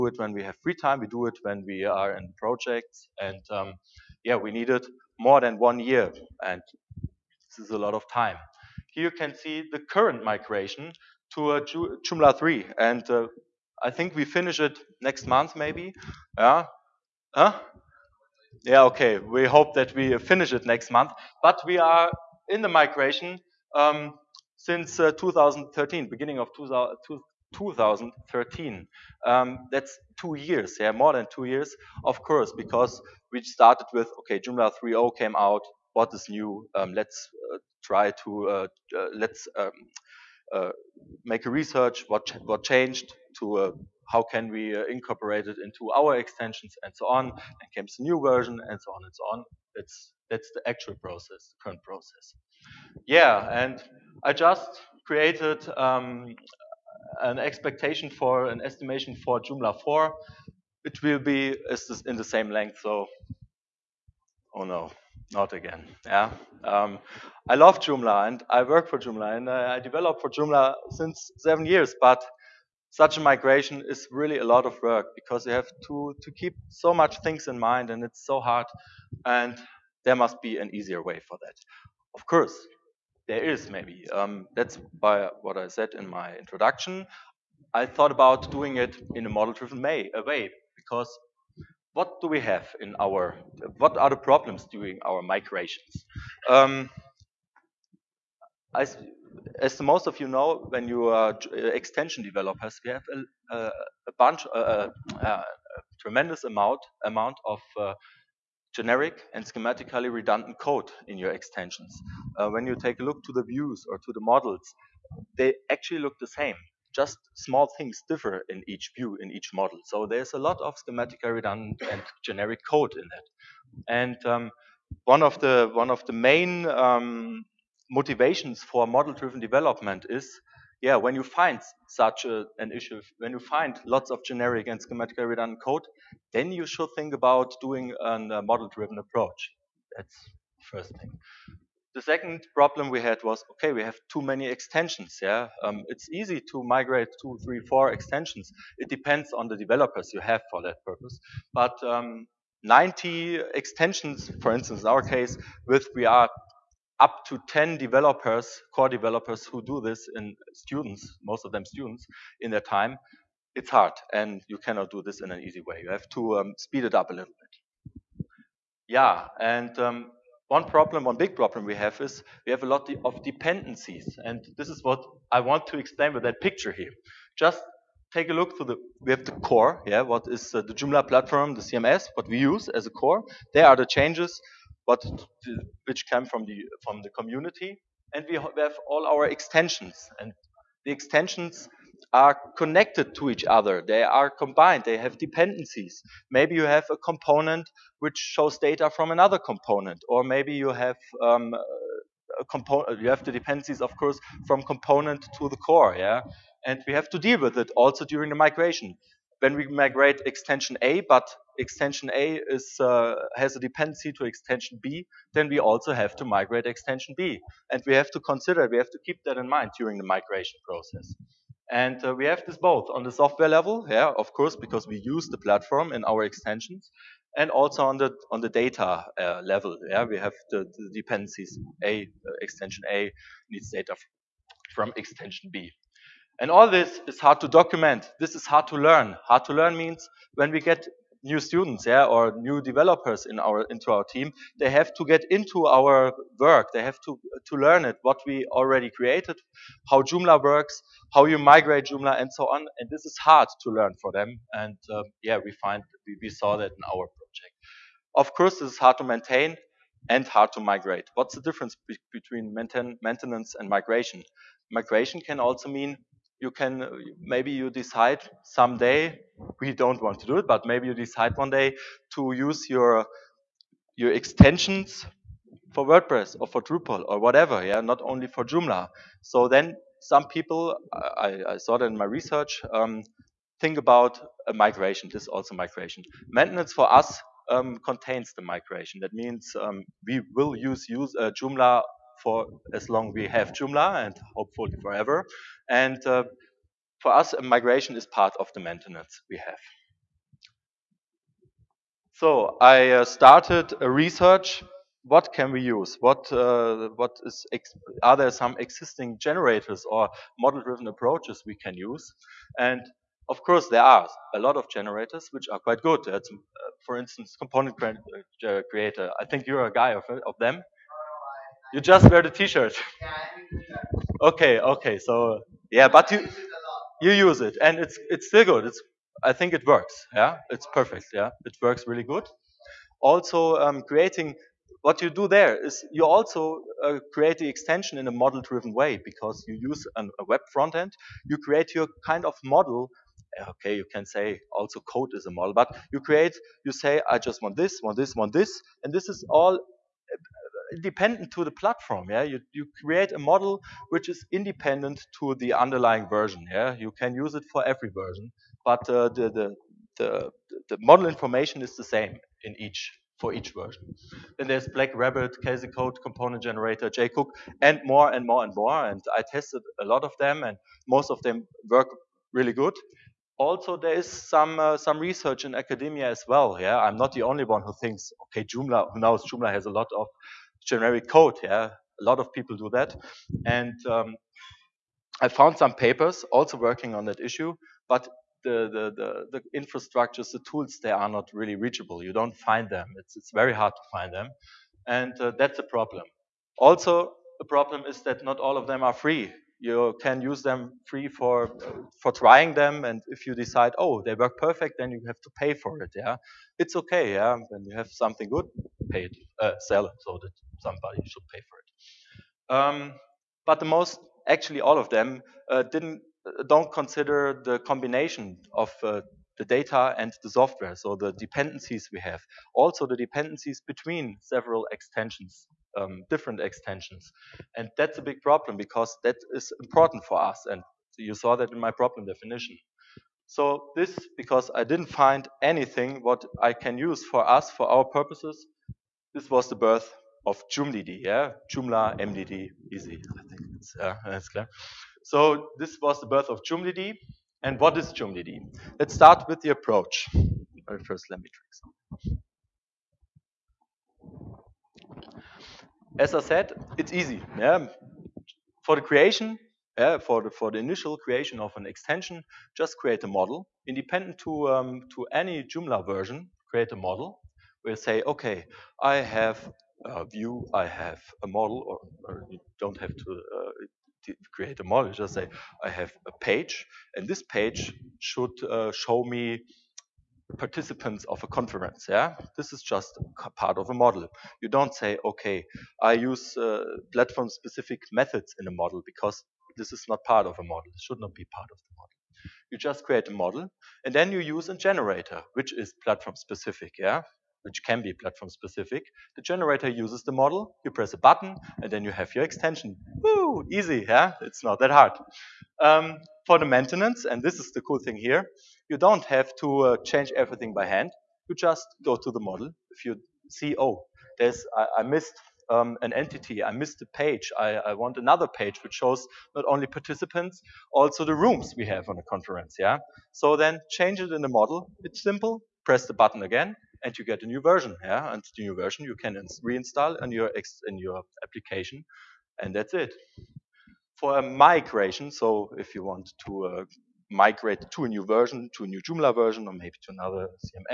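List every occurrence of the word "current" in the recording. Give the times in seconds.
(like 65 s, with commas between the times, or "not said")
9 s, 51 s.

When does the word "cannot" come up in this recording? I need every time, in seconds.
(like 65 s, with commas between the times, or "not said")
164 s.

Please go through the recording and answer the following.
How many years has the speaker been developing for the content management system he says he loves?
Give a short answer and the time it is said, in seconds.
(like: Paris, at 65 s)
7, at 71 s.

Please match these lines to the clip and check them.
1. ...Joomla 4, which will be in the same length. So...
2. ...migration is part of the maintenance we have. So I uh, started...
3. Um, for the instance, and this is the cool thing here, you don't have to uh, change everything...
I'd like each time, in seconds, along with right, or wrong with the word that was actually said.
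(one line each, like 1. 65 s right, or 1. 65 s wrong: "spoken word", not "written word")
1. 59 s right
2. 297 s right
3. 505 s wrong: "maintenance", not "instance".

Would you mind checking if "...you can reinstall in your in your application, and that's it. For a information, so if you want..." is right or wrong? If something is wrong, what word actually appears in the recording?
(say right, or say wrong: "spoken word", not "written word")
wrong: "migration", not "information".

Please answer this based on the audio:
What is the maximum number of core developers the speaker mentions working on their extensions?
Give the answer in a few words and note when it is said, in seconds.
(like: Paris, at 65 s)
10, at 157 s.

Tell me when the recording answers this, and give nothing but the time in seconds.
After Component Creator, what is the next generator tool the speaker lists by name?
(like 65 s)
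364 s.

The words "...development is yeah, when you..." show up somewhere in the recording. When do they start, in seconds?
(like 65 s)
129 s.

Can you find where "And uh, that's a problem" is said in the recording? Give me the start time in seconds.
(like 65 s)
394 s.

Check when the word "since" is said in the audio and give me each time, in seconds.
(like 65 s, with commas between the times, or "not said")
24 s, 70 s.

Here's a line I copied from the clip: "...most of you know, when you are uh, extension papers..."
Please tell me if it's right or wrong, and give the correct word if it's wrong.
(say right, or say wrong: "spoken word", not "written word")
wrong: "developers", not "papers".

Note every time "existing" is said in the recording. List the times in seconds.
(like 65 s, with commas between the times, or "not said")
308 s.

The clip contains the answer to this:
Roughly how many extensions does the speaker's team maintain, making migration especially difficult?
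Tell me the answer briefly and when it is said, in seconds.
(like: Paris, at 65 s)
90, at 152 s.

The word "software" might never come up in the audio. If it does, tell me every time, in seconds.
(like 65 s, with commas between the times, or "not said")
223 s, 420 s.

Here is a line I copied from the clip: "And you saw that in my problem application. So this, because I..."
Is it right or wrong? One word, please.
wrong.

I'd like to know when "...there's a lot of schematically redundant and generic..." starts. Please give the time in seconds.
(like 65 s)
120 s.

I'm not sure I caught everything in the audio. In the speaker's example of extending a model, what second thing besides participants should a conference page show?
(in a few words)
rooms.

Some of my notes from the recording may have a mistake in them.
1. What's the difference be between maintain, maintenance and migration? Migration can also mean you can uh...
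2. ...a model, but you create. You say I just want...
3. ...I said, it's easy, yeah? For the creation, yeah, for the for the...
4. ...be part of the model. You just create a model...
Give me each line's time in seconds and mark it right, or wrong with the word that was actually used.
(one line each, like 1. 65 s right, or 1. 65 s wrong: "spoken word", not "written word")
1. 261 s right
2. 345 s right
3. 456 s right
4. 491 s right.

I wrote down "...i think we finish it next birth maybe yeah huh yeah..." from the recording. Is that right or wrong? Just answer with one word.
wrong.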